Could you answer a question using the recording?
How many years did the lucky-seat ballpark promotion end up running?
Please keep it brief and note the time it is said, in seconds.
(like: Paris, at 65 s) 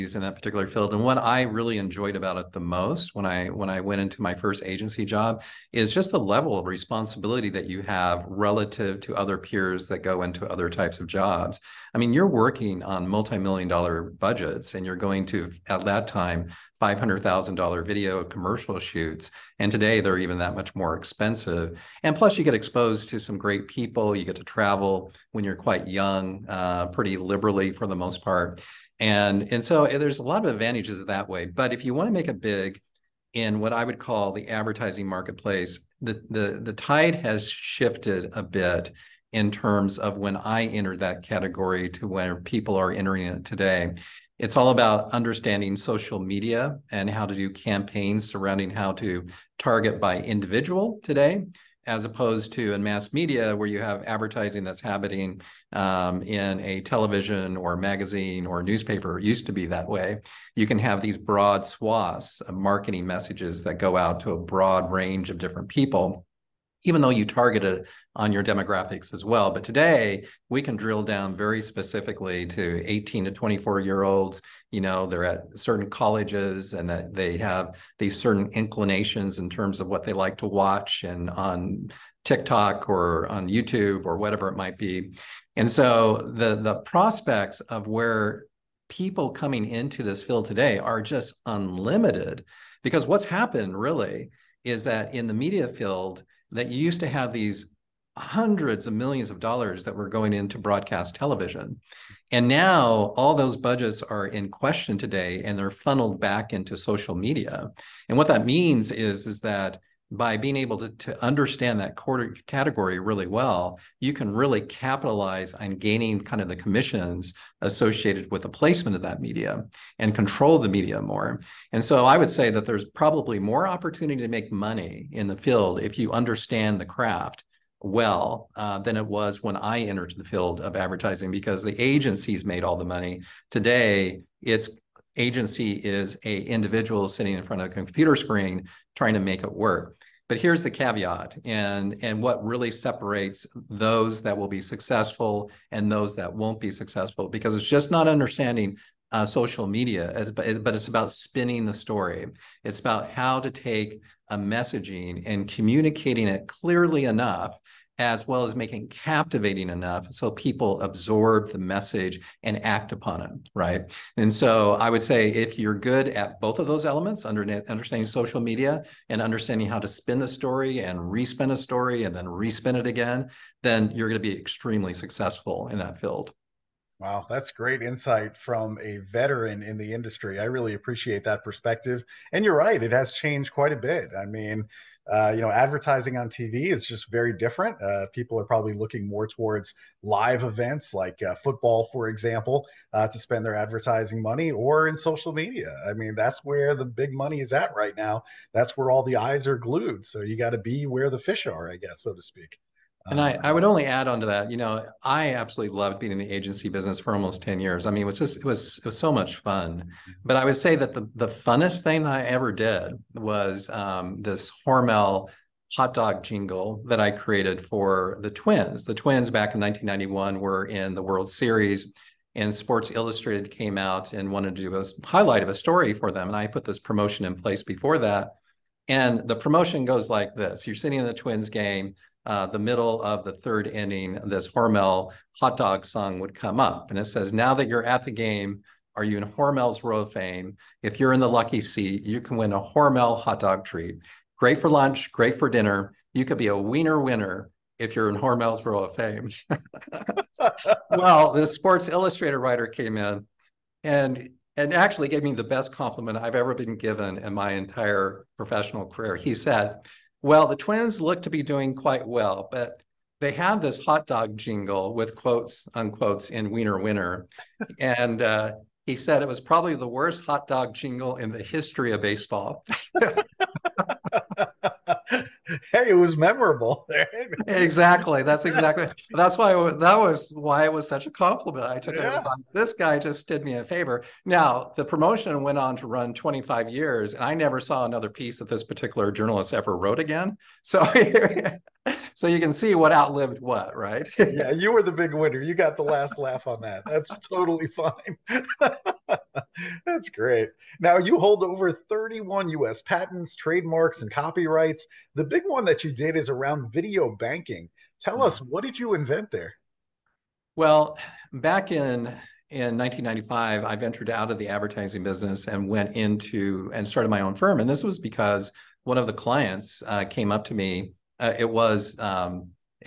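25 years, at 286 s.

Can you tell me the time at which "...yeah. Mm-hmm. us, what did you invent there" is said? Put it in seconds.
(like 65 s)
308 s.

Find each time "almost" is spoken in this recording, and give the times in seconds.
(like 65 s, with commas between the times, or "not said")
207 s.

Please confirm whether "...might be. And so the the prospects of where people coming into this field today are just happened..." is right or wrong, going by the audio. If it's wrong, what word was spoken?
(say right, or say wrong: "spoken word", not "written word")
wrong: "unlimited", not "happened".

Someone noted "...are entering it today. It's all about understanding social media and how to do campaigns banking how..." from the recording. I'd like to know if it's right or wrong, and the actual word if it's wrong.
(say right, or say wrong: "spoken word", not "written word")
wrong: "surrounding", not "banking".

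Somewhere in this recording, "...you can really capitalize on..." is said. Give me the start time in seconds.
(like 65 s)
114 s.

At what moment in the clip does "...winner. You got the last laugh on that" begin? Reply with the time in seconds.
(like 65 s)
295 s.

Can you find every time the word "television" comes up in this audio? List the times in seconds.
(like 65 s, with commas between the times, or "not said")
56 s, 101 s.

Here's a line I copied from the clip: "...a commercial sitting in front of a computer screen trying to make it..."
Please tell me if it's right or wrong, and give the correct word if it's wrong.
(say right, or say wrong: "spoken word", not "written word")
wrong: "individual", not "commercial".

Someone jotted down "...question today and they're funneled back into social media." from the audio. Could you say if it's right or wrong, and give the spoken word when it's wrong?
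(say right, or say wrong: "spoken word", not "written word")
right.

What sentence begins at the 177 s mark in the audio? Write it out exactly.
Wow, that's great insight from a veteran in the industry.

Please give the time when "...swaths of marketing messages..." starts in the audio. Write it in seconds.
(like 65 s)
61 s.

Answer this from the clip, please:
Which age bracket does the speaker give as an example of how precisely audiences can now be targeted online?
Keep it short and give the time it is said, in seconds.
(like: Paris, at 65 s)
18 to 24, at 72 s.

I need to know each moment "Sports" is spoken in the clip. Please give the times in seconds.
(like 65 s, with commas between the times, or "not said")
222 s, 251 s.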